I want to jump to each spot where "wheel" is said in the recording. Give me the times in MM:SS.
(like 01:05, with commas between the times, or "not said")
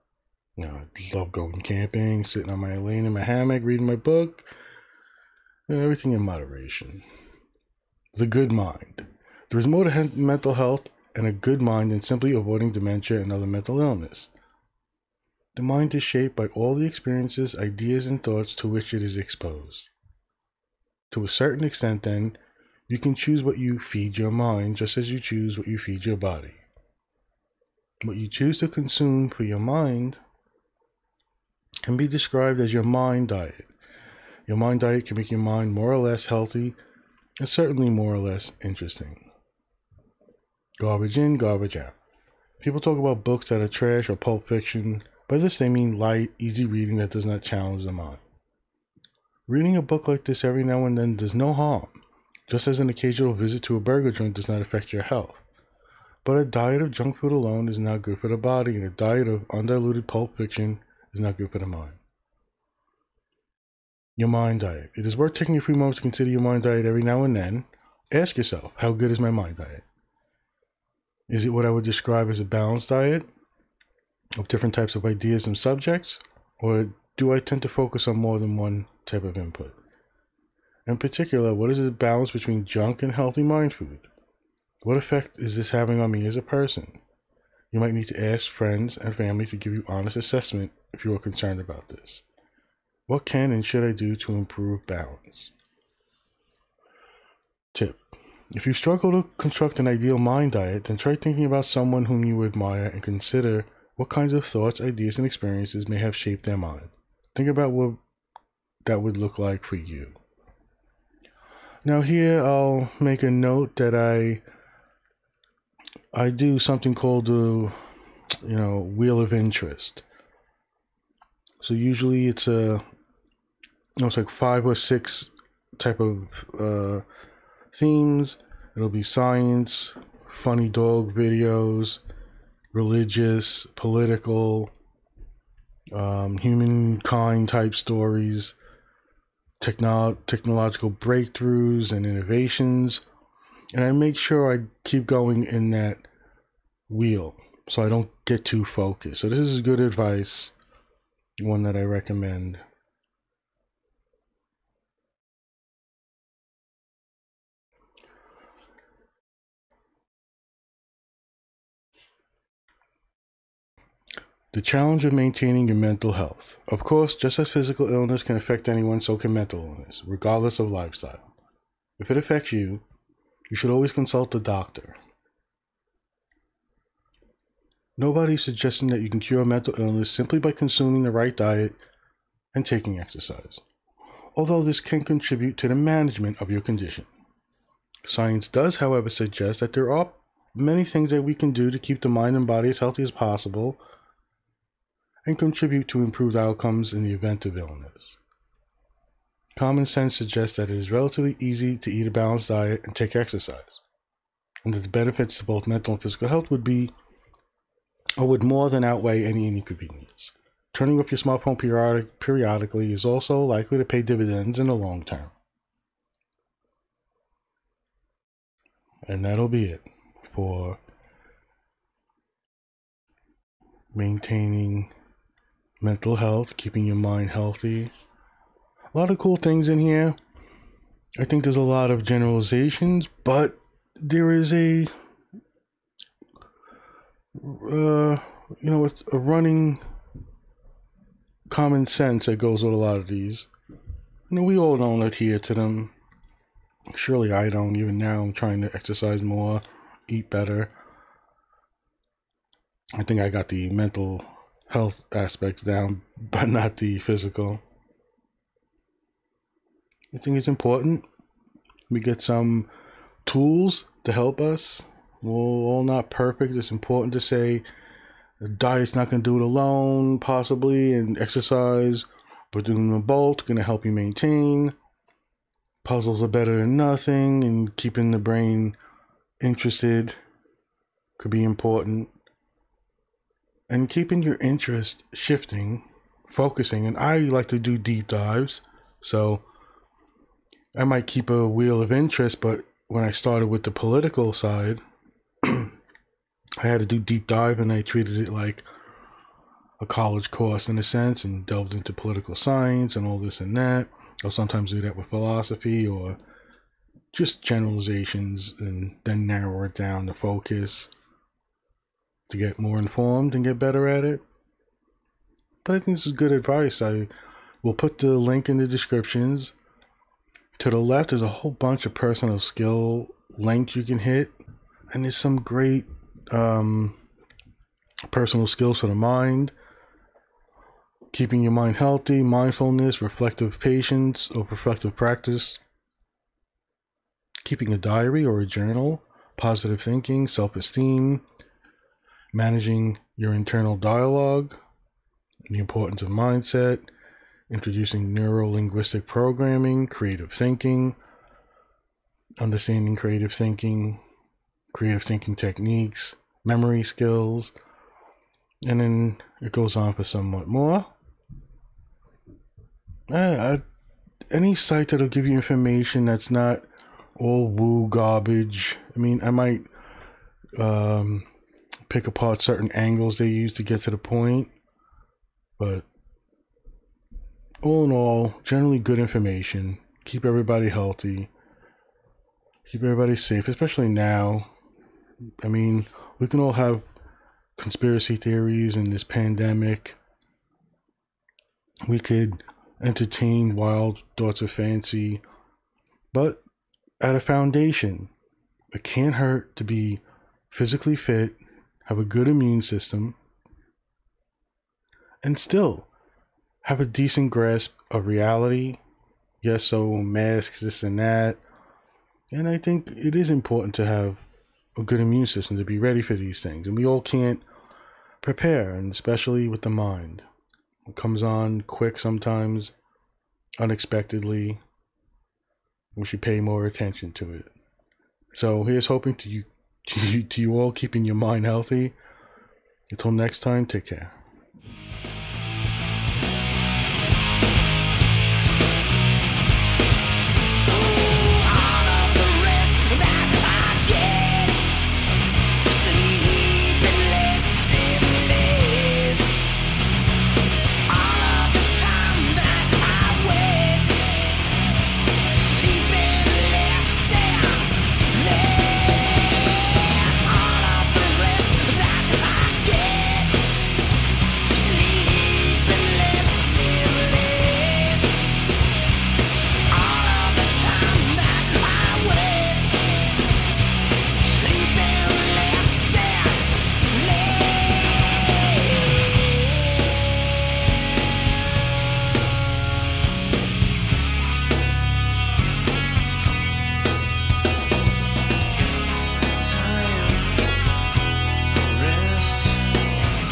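01:58, 02:26, 04:51.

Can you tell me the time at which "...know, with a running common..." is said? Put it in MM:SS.
03:58.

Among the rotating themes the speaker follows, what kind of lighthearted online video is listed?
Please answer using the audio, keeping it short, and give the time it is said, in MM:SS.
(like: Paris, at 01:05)
funny dog videos, at 02:10.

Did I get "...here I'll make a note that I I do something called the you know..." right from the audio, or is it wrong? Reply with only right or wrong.
right.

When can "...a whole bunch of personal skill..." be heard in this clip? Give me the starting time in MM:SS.
05:21.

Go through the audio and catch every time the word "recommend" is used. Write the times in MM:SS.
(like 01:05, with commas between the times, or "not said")
02:31.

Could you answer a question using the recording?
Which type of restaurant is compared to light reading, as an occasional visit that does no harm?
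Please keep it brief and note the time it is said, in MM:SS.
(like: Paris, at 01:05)
burger joint, at 00:53.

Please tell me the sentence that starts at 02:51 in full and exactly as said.
If it affects you, you should always consult a doctor.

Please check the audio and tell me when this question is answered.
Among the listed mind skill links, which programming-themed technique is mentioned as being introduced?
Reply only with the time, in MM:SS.
05:48.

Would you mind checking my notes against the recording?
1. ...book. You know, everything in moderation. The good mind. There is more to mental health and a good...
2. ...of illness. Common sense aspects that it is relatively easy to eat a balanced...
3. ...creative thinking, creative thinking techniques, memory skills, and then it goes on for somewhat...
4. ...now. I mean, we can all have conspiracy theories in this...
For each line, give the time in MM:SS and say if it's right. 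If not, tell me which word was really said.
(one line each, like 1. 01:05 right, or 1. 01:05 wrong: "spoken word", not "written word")
1. 00:03 right
2. 03:17 wrong: "suggests", not "aspects"
3. 05:52 right
4. 06:23 right.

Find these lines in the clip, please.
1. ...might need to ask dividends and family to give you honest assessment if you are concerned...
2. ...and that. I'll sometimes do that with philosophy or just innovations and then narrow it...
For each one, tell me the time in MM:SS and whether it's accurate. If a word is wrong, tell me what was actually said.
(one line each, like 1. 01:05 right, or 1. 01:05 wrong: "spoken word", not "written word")
1. 01:27 wrong: "friends", not "dividends"
2. 05:03 wrong: "generalizations", not "innovations".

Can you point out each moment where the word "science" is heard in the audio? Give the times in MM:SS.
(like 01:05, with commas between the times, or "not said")
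02:09, 03:08, 05:02.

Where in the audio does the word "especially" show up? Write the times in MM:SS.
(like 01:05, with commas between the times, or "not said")
06:23, 06:58.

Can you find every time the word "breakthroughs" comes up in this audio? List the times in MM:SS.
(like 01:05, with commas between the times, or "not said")
02:20.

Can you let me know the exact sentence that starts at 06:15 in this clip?
But all in all, generally good information.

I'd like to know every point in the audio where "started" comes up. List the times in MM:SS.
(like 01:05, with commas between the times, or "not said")
04:53.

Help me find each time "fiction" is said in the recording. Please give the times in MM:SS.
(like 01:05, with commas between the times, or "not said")
00:44, 01:00.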